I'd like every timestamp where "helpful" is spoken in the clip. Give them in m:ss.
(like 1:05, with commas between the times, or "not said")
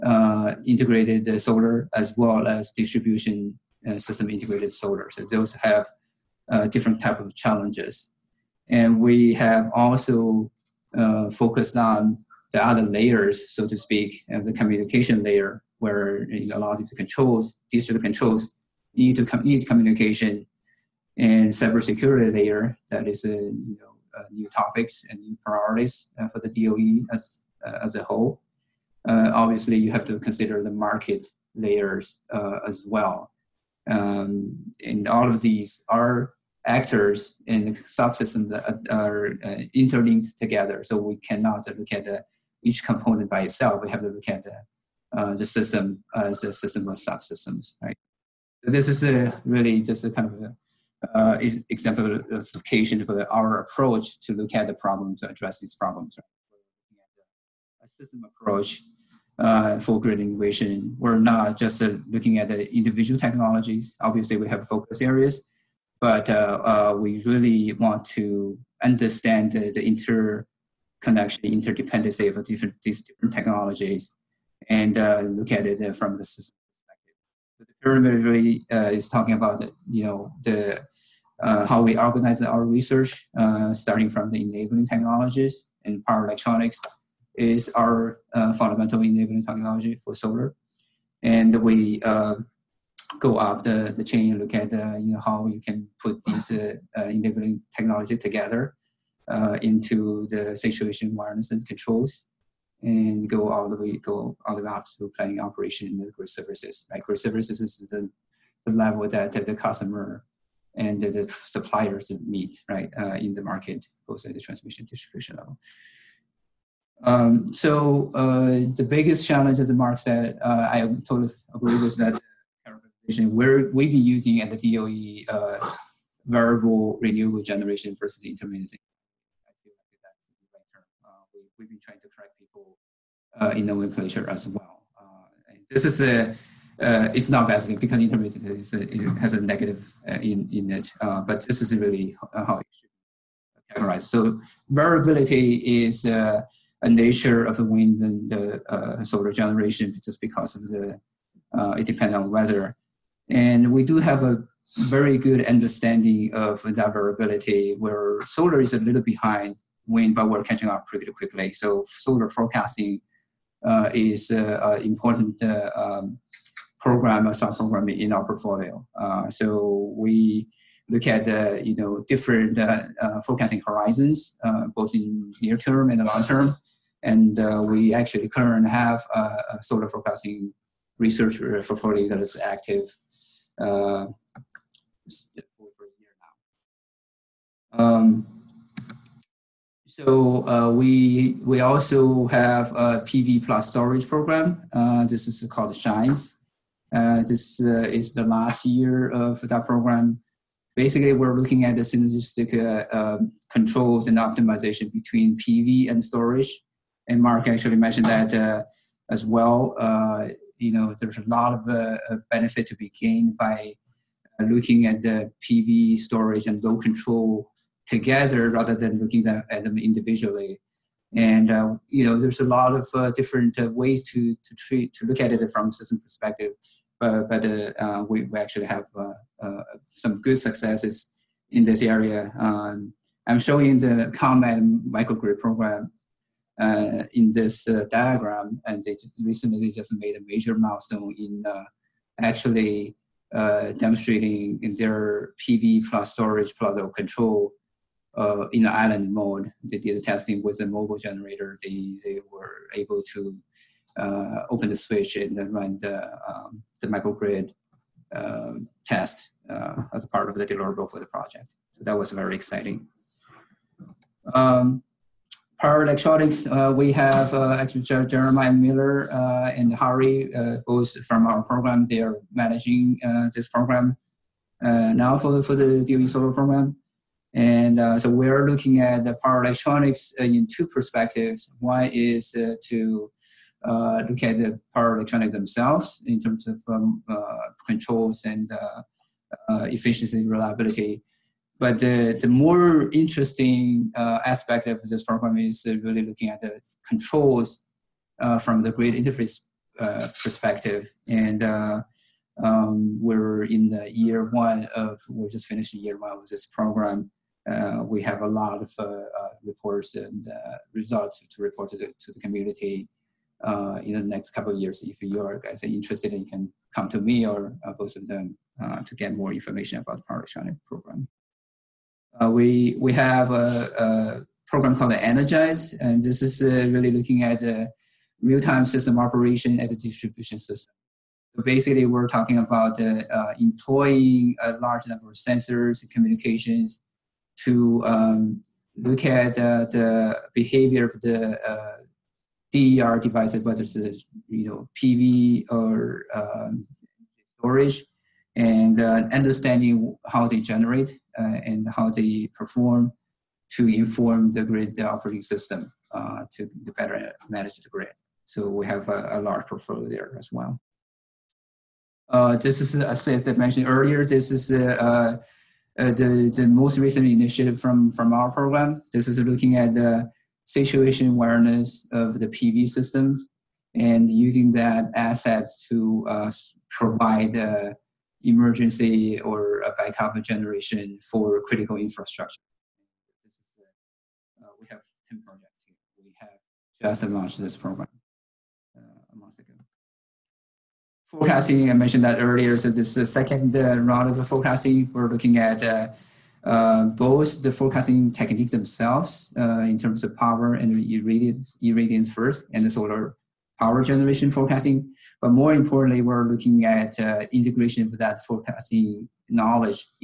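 not said.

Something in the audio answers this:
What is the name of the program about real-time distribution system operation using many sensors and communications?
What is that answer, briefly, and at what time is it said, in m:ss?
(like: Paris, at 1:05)
ENERGISE, at 5:24.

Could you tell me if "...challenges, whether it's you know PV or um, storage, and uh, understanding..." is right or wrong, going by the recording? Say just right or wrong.
wrong.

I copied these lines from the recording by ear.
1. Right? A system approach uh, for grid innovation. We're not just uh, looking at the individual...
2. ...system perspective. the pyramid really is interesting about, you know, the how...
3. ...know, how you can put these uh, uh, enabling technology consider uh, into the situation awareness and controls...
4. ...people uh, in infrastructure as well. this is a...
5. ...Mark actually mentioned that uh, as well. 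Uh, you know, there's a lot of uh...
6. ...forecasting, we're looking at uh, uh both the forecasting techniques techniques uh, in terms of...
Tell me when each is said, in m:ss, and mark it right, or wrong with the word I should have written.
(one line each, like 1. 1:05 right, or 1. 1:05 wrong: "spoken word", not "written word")
1. 0:56 right
2. 1:16 wrong: "talking", not "interesting"
3. 1:35 wrong: "together", not "consider"
4. 2:12 wrong: "nomenclature", not "infrastructure"
5. 3:27 right
6. 6:34 wrong: "themselves", not "techniques".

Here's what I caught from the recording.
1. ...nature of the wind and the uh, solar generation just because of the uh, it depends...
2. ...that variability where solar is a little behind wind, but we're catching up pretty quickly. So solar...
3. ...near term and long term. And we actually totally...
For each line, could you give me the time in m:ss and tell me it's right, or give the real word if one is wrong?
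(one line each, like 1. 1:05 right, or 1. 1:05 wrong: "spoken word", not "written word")
1. 2:26 right
2. 2:36 right
3. 2:55 wrong: "currently", not "totally".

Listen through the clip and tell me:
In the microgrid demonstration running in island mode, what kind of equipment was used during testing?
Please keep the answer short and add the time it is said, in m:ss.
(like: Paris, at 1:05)
a mobile generator, at 4:10.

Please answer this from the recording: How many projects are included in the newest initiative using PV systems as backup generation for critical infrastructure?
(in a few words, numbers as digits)
10.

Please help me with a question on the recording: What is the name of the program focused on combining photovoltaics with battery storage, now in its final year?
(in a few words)
SHINES.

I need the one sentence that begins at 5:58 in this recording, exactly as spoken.
So we have a, a large portfolio there as well.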